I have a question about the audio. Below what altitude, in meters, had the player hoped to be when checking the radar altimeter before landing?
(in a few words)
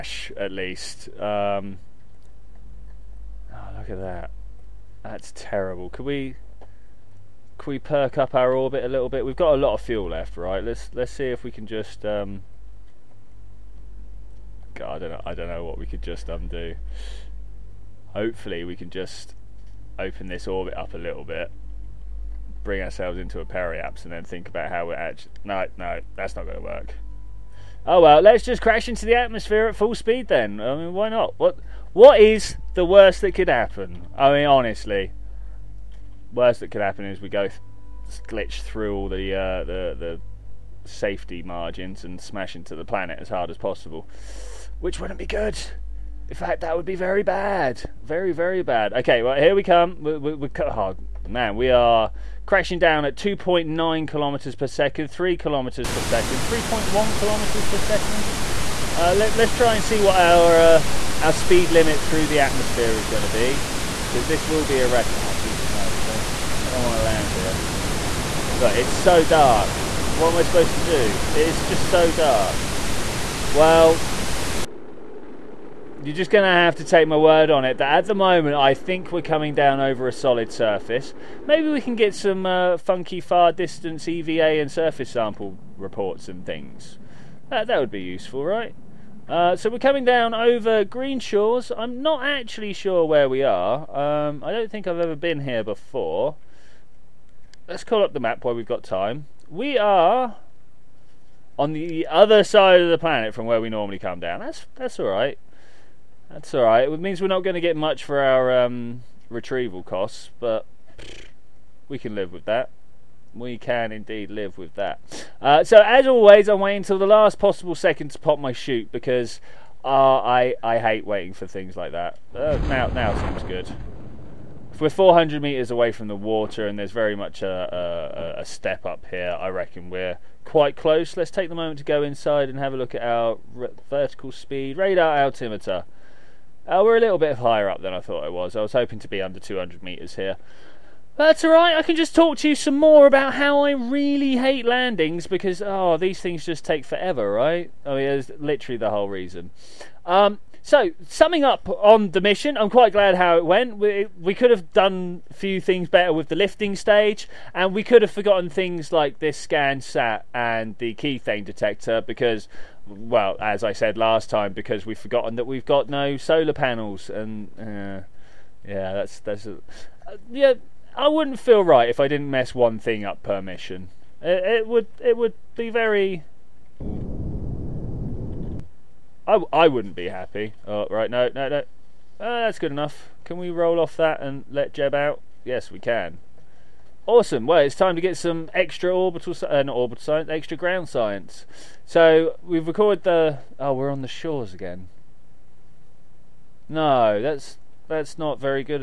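200 meters.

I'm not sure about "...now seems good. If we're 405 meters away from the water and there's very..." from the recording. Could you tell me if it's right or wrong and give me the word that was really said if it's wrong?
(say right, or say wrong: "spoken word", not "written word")
wrong: "400", not "405".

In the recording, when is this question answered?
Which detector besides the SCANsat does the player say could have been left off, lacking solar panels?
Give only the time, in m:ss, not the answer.
2:40.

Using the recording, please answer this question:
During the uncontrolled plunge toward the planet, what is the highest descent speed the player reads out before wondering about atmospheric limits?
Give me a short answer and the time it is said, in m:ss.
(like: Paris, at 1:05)
3.1 kilometers per second, at 0:56.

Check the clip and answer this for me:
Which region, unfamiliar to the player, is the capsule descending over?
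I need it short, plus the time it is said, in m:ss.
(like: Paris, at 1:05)
Green Shores, at 1:30.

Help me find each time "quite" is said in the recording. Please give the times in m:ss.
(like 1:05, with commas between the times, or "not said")
2:10, 2:32.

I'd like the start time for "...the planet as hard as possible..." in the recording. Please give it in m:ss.
0:42.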